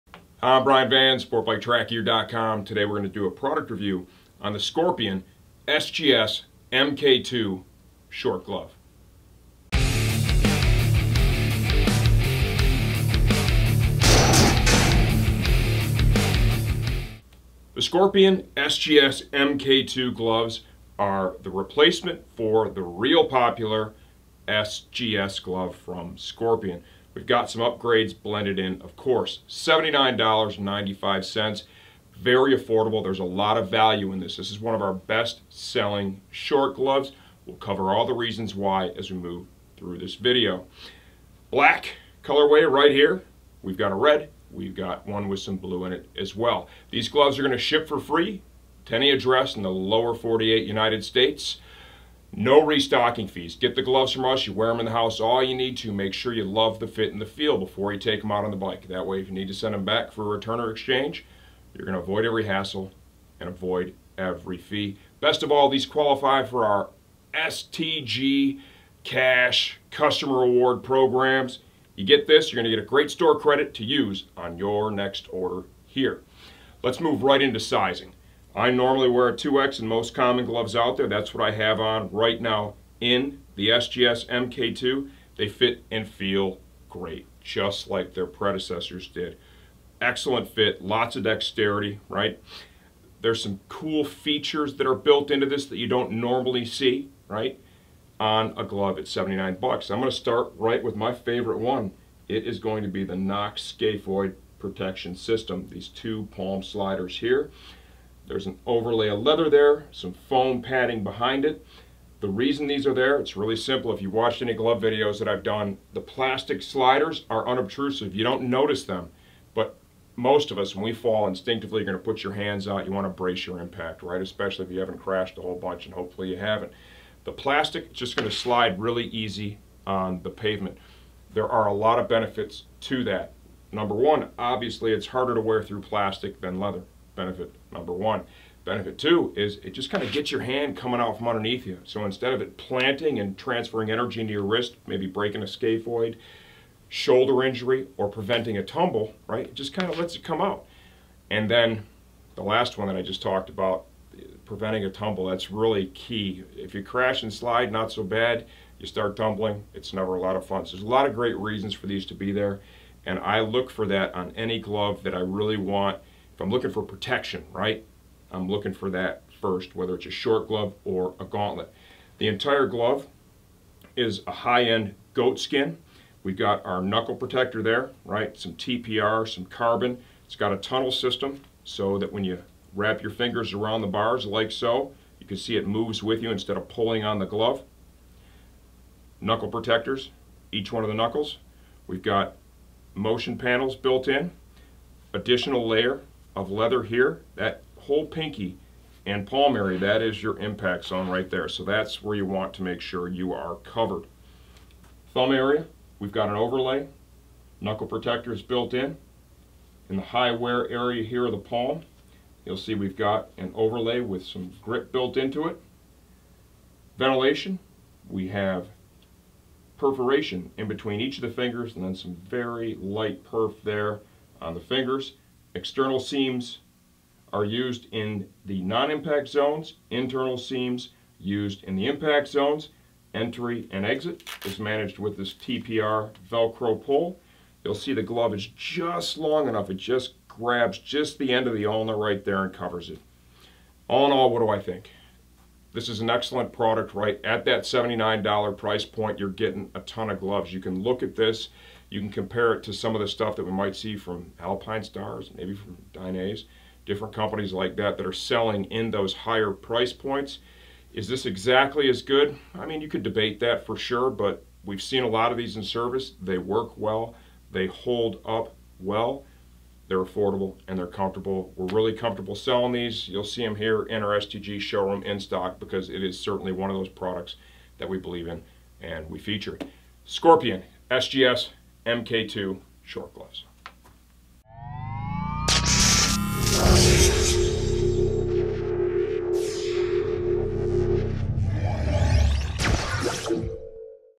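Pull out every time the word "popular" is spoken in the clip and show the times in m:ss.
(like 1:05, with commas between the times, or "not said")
0:23.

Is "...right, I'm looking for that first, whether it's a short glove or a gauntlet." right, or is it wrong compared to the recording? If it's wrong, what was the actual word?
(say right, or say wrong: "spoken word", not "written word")
right.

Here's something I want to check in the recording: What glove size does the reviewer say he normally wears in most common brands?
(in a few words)
2X.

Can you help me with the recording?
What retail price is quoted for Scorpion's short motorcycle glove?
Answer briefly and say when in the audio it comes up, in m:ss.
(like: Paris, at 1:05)
$79.95, at 0:29.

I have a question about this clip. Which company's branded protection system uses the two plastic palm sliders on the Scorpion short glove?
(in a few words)
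Knox.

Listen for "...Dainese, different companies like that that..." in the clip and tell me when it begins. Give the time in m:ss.
4:15.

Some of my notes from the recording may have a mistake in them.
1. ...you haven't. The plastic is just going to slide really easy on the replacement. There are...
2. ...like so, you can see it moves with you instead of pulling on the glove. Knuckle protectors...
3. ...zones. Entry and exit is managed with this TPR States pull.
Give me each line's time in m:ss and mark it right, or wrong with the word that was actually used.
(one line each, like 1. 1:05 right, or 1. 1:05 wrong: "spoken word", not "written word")
1. 2:06 wrong: "pavement", not "replacement"
2. 3:04 right
3. 3:52 wrong: "Velcro", not "States".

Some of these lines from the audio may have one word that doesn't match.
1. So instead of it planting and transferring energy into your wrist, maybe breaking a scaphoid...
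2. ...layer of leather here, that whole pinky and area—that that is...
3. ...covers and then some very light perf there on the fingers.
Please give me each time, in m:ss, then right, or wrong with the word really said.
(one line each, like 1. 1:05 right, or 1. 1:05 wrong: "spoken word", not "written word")
1. 2:21 right
2. 3:15 right
3. 3:41 wrong: "fingers", not "covers".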